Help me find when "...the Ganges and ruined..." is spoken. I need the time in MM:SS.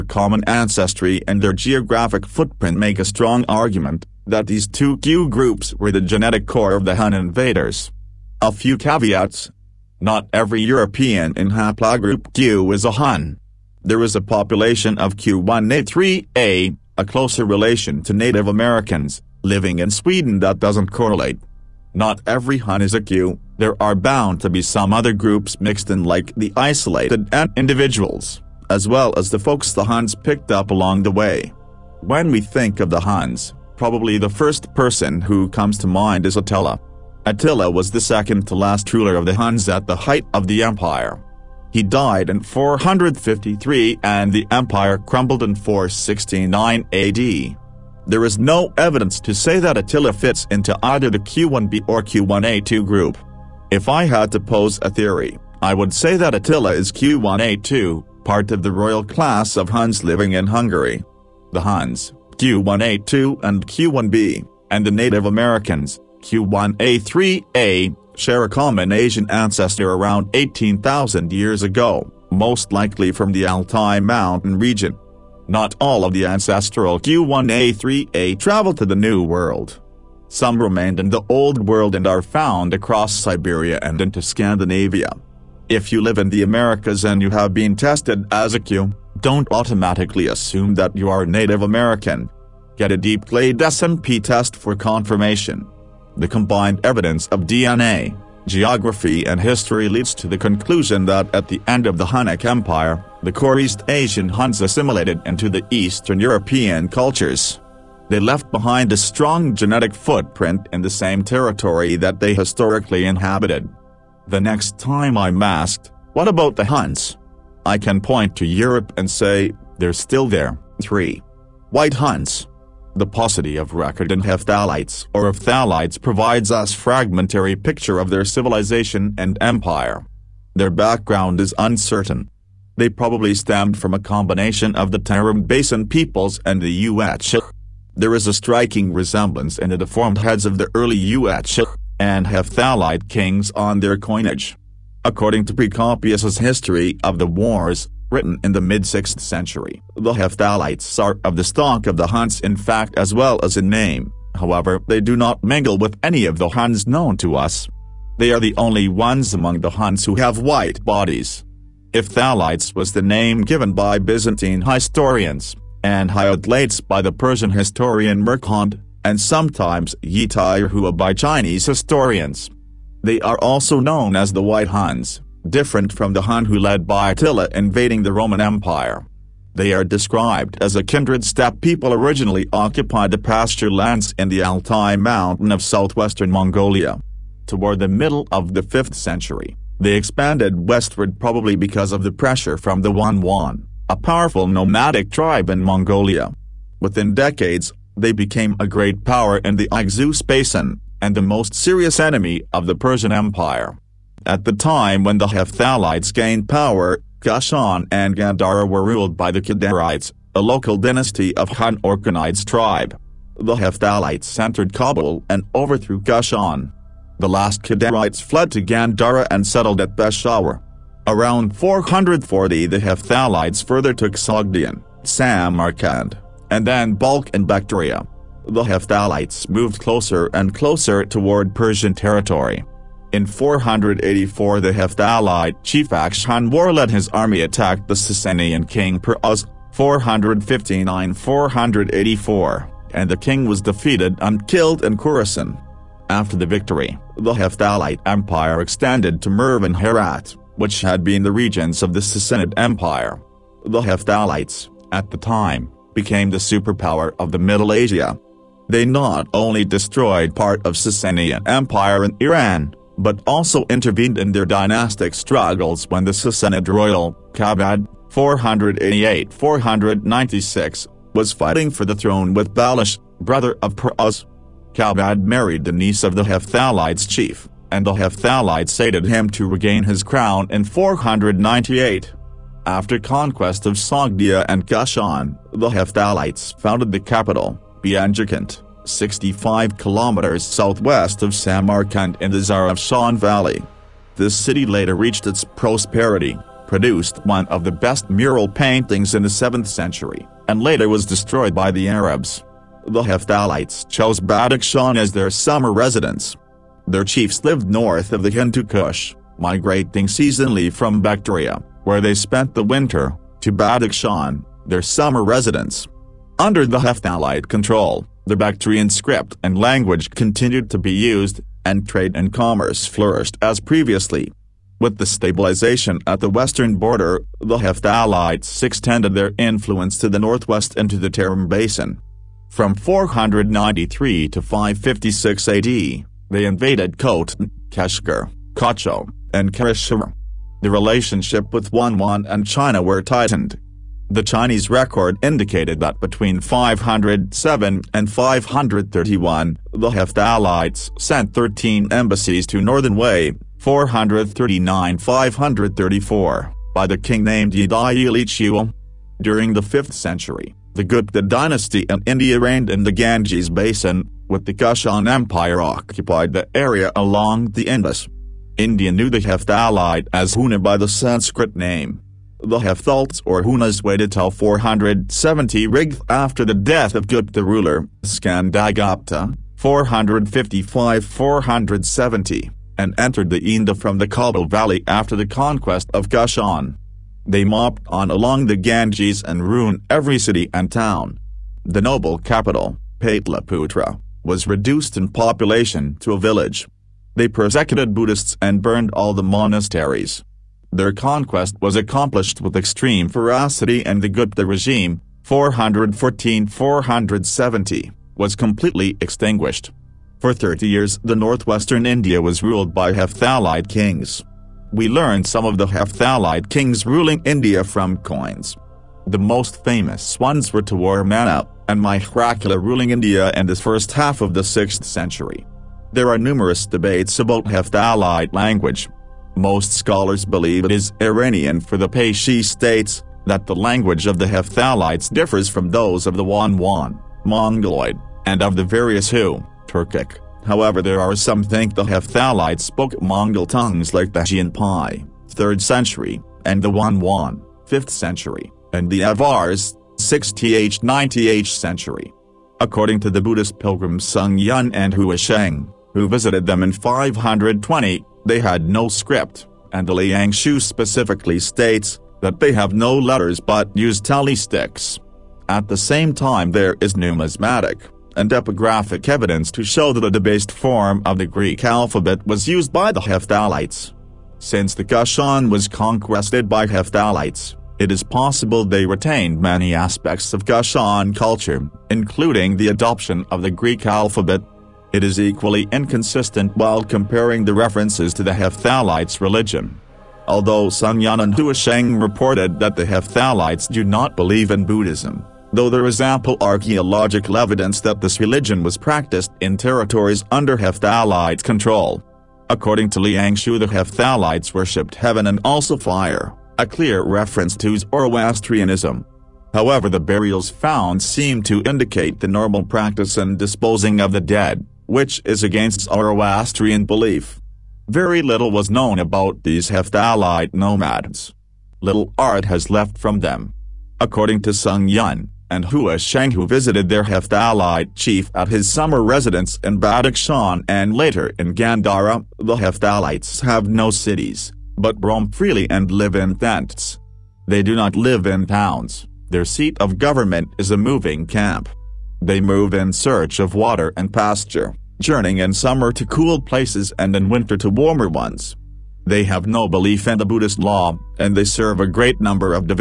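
06:28.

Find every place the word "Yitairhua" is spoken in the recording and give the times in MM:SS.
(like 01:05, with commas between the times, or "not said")
02:50.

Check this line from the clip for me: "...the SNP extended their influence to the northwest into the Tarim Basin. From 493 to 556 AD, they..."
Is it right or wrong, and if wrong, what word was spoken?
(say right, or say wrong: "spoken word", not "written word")
wrong: "Hephthalites", not "SNP".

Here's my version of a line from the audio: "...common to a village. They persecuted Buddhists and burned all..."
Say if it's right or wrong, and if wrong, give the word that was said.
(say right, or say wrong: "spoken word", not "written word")
wrong: "population", not "common".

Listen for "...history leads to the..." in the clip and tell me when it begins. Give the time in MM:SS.
01:39.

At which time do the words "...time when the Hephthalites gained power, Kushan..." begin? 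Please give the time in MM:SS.
03:24.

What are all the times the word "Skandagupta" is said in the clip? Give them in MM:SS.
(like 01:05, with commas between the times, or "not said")
06:18.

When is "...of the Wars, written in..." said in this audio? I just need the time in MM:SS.
02:27.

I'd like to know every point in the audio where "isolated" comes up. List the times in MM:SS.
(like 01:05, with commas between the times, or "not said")
00:26.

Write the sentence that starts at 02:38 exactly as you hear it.
They are the only ones among the Huns who have white bodies.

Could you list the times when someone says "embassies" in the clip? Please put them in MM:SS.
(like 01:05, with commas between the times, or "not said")
05:51.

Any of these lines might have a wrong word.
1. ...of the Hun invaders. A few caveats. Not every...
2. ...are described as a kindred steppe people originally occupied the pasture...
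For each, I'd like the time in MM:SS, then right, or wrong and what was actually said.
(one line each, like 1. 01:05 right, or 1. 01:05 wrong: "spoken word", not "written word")
1. 00:06 right
2. 02:59 right.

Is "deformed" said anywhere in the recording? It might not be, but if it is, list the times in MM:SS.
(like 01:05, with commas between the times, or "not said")
02:19.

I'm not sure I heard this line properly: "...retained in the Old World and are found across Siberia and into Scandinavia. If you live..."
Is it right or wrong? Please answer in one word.
wrong.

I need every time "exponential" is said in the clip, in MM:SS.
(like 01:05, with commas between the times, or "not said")
not said.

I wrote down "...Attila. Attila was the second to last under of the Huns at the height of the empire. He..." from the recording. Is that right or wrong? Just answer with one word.
wrong.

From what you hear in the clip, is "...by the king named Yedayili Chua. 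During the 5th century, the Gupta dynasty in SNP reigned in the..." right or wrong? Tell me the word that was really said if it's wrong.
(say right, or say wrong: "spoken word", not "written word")
wrong: "India", not "SNP".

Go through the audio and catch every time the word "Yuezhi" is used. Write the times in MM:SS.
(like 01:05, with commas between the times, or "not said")
02:16, 02:20.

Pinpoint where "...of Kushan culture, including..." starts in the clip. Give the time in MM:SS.
08:00.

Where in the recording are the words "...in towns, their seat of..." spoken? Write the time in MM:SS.
08:58.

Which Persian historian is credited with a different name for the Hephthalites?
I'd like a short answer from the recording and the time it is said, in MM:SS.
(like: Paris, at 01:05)
Mirkhond, at 02:48.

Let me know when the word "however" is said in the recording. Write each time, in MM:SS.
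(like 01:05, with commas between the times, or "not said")
02:34, 07:20, 08:29.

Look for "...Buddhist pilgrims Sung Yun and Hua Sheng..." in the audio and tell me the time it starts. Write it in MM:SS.
07:33.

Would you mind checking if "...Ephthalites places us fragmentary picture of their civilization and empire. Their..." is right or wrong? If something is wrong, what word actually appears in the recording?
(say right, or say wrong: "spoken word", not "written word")
wrong: "provides", not "places".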